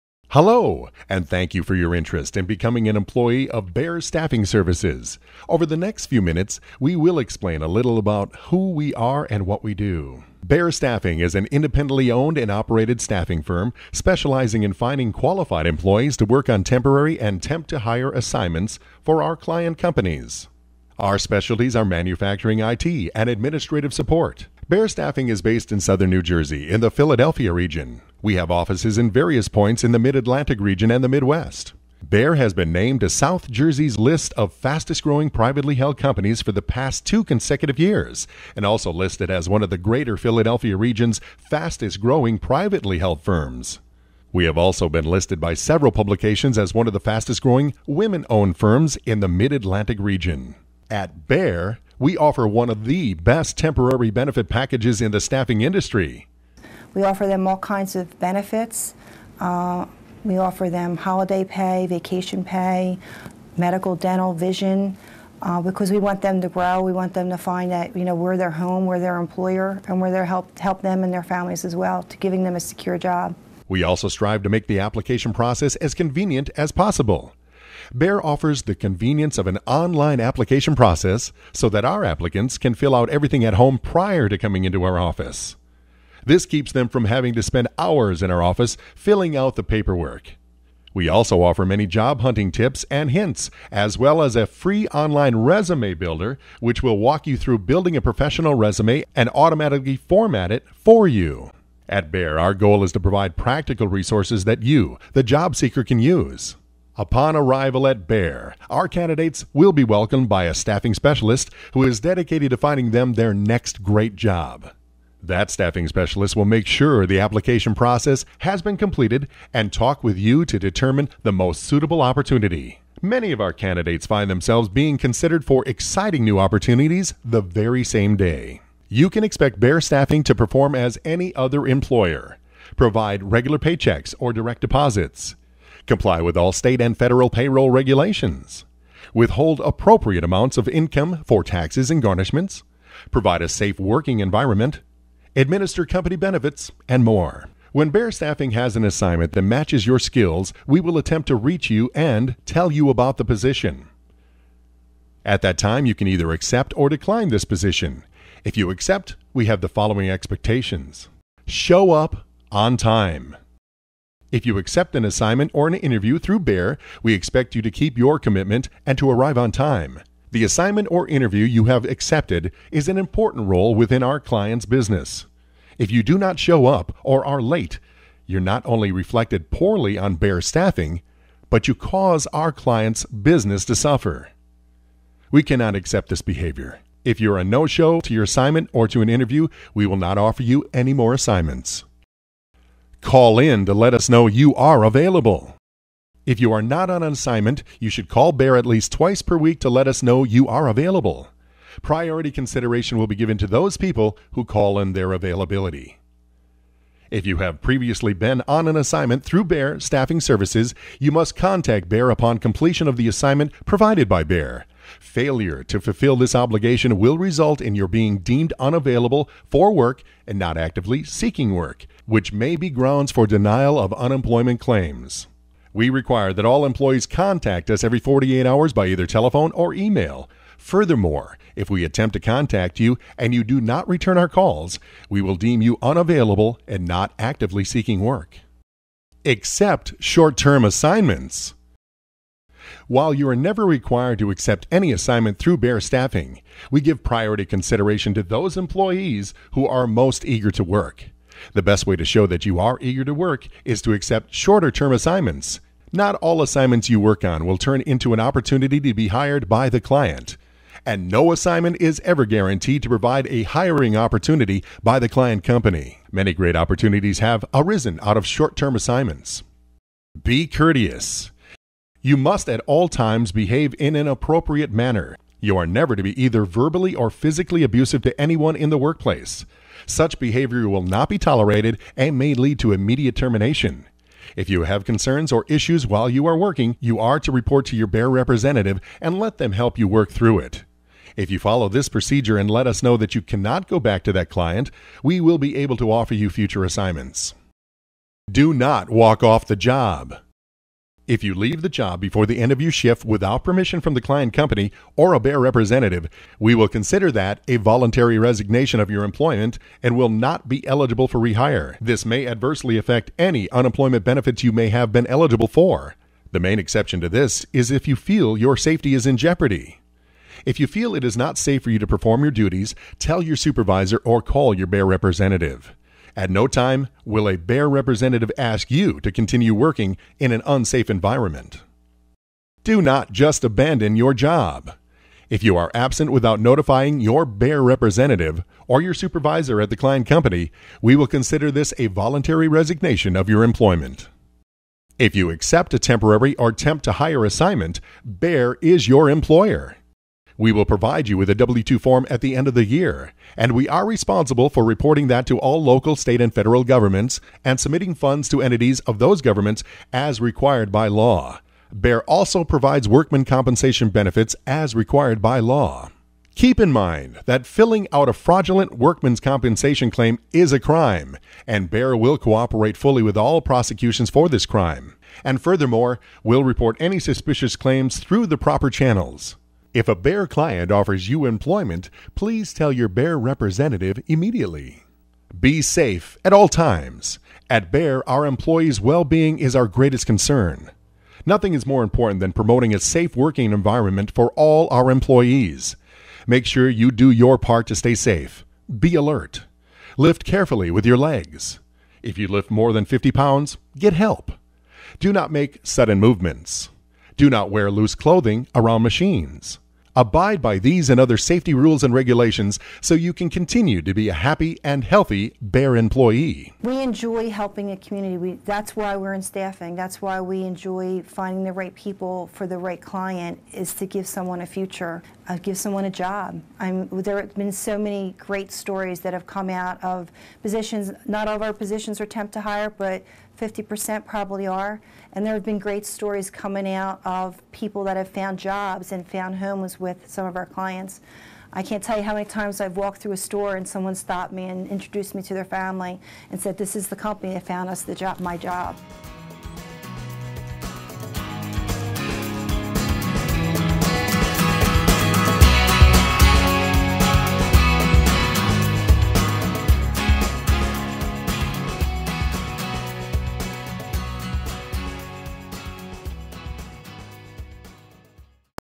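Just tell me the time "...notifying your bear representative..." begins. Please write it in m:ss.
5:36.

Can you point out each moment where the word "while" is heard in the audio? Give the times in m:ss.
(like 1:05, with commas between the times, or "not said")
4:02, 4:45.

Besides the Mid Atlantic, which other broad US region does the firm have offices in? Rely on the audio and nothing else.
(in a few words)
Midwest.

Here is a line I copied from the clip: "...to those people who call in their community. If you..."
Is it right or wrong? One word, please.
wrong.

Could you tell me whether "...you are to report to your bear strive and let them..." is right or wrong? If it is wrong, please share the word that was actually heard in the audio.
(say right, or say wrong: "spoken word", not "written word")
wrong: "representative", not "strive".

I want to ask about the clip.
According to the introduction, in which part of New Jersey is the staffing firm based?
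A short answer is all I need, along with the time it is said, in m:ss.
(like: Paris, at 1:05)
southern New Jersey, at 0:25.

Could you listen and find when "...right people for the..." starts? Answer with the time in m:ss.
7:01.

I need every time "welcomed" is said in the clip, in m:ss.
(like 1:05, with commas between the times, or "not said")
1:49.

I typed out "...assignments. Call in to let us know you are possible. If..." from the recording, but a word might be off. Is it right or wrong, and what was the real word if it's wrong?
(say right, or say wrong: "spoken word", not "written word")
wrong: "available", not "possible".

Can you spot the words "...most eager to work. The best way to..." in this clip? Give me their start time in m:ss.
4:09.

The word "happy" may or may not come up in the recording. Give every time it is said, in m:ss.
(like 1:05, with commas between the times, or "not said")
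6:54.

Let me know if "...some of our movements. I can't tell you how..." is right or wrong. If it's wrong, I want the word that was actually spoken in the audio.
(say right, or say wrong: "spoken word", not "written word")
wrong: "clients", not "movements".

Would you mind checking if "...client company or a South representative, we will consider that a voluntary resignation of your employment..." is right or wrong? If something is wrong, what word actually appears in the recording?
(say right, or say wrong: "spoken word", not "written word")
wrong: "Bear", not "South".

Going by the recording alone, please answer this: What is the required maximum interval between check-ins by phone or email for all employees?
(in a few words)
48 hours.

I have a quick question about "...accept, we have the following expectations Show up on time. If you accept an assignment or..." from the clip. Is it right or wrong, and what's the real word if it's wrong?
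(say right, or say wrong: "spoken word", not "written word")
right.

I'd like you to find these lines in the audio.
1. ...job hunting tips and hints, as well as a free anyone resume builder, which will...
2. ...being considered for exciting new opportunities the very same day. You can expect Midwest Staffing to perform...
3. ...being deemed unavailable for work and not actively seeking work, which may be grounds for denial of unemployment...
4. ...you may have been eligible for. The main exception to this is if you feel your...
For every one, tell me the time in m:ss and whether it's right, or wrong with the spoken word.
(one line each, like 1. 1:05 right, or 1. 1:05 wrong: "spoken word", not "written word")
1. 1:31 wrong: "online", not "anyone"
2. 2:04 wrong: "Bear", not "Midwest"
3. 3:37 right
4. 5:14 right.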